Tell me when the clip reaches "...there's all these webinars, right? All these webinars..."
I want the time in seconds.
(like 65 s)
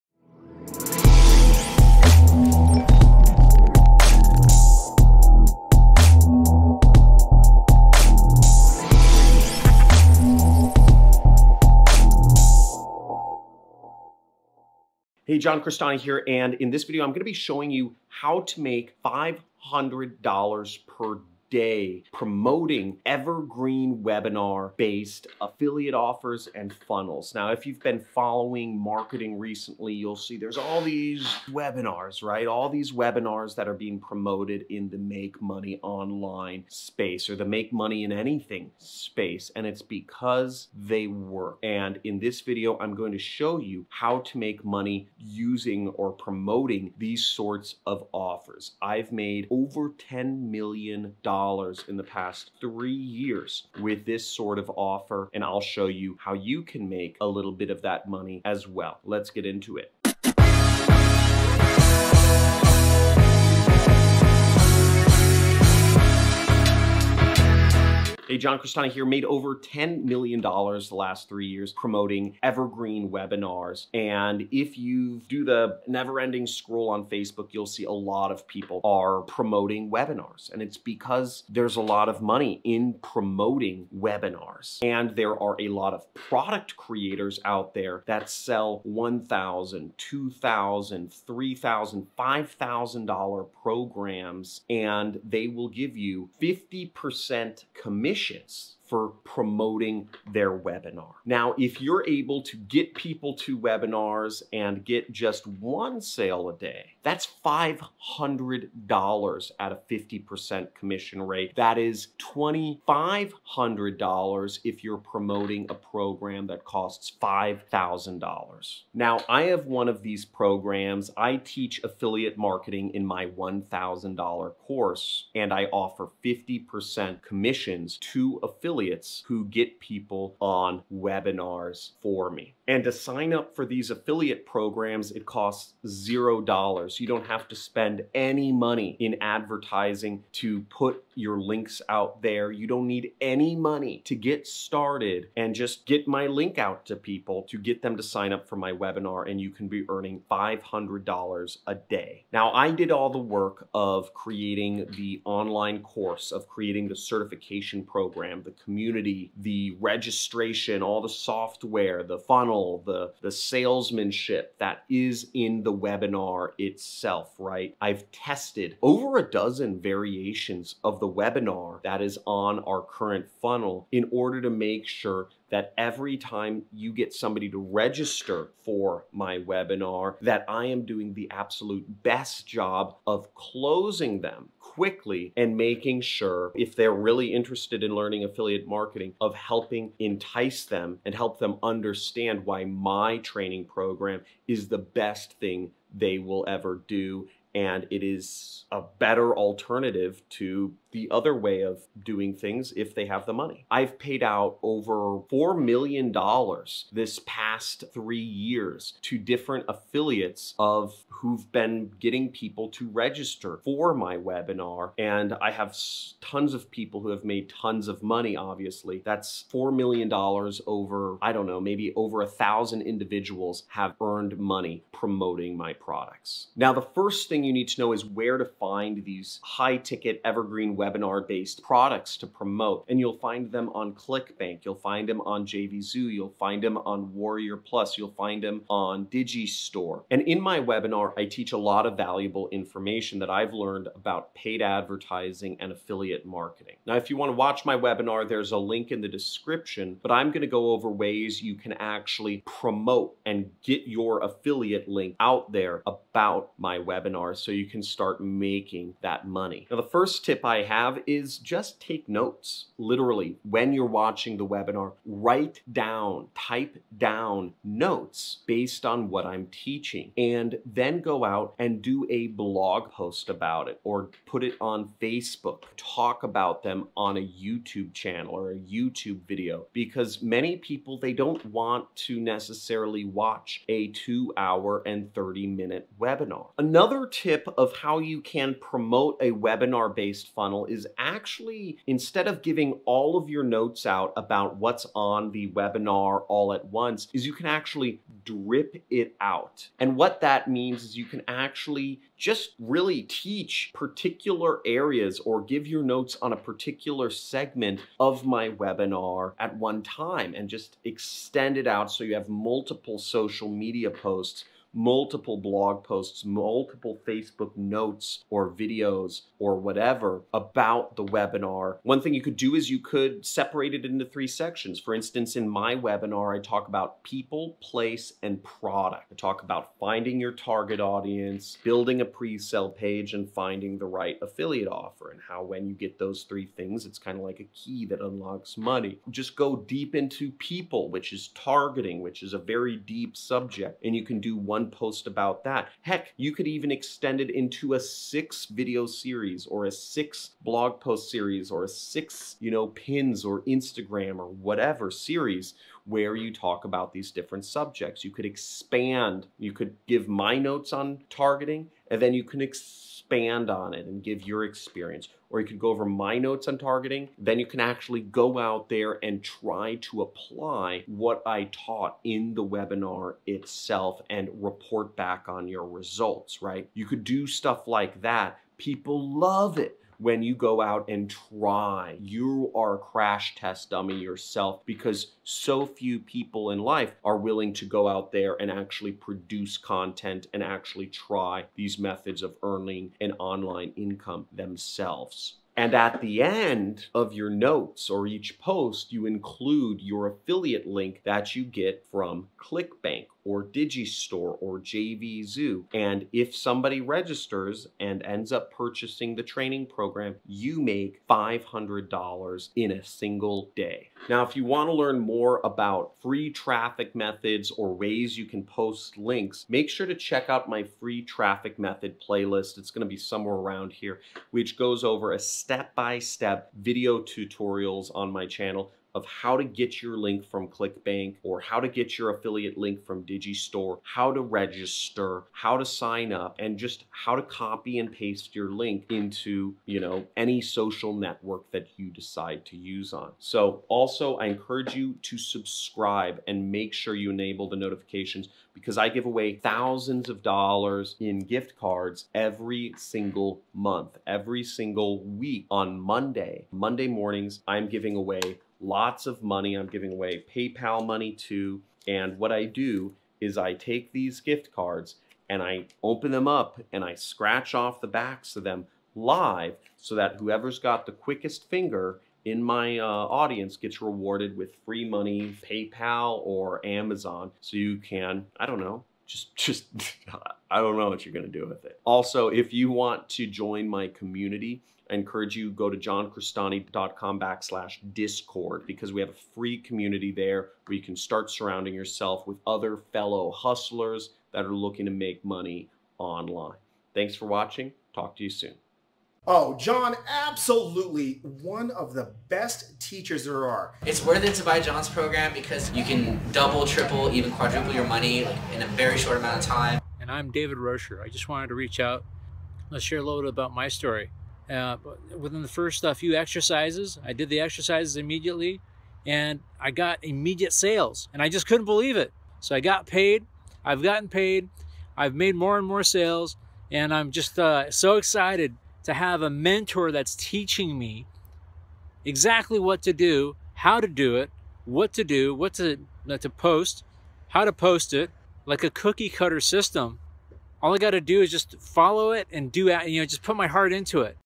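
30 s.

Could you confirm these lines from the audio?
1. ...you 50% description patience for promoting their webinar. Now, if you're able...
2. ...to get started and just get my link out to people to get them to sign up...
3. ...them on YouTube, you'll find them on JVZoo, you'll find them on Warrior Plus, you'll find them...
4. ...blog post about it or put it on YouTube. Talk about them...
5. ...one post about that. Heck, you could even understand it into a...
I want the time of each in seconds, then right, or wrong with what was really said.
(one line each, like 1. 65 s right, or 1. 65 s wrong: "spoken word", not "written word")
1. 95 s wrong: "commission", not "description"
2. 144 s right
3. 233 s wrong: "ClickBank", not "YouTube"
4. 272 s wrong: "Facebook", not "YouTube"
5. 344 s wrong: "extend", not "understand".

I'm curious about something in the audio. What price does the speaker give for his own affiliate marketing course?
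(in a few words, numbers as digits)
$1,000.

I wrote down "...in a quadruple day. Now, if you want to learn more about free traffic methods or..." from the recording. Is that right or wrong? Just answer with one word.
wrong.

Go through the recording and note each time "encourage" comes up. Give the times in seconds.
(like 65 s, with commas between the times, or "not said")
444 s, 484 s.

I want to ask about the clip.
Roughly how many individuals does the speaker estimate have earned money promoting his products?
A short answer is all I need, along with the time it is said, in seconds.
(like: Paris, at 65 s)
over a thousand, at 221 s.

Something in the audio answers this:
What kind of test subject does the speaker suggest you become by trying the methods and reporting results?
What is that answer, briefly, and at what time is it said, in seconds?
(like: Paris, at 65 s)
Crash test dummy, at 382 s.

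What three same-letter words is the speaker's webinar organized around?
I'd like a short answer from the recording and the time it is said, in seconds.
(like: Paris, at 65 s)
People, place, and product, at 327 s.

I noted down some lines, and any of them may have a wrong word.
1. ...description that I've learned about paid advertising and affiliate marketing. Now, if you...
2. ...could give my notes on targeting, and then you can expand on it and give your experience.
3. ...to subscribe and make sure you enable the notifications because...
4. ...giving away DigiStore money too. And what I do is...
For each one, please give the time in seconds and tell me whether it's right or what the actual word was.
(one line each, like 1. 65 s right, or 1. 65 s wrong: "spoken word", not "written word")
1. 242 s wrong: "information", not "description"
2. 359 s right
3. 445 s right
4. 459 s wrong: "PayPal", not "DigiStore".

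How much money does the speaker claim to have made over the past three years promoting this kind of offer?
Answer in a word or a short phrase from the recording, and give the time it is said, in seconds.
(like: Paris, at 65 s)
$10 million, at 49 s.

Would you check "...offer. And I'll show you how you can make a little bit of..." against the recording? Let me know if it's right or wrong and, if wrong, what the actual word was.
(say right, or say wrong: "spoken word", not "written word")
right.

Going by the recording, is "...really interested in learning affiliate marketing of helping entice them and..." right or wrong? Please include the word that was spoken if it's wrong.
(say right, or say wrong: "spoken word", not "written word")
right.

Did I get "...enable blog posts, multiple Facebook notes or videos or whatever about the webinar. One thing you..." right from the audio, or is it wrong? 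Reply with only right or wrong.
wrong.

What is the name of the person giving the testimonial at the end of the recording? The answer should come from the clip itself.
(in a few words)
David Rocher.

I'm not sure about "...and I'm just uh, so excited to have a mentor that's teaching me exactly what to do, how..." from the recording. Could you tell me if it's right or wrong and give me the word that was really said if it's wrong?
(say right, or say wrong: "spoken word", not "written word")
right.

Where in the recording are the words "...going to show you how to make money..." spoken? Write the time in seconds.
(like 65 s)
42 s.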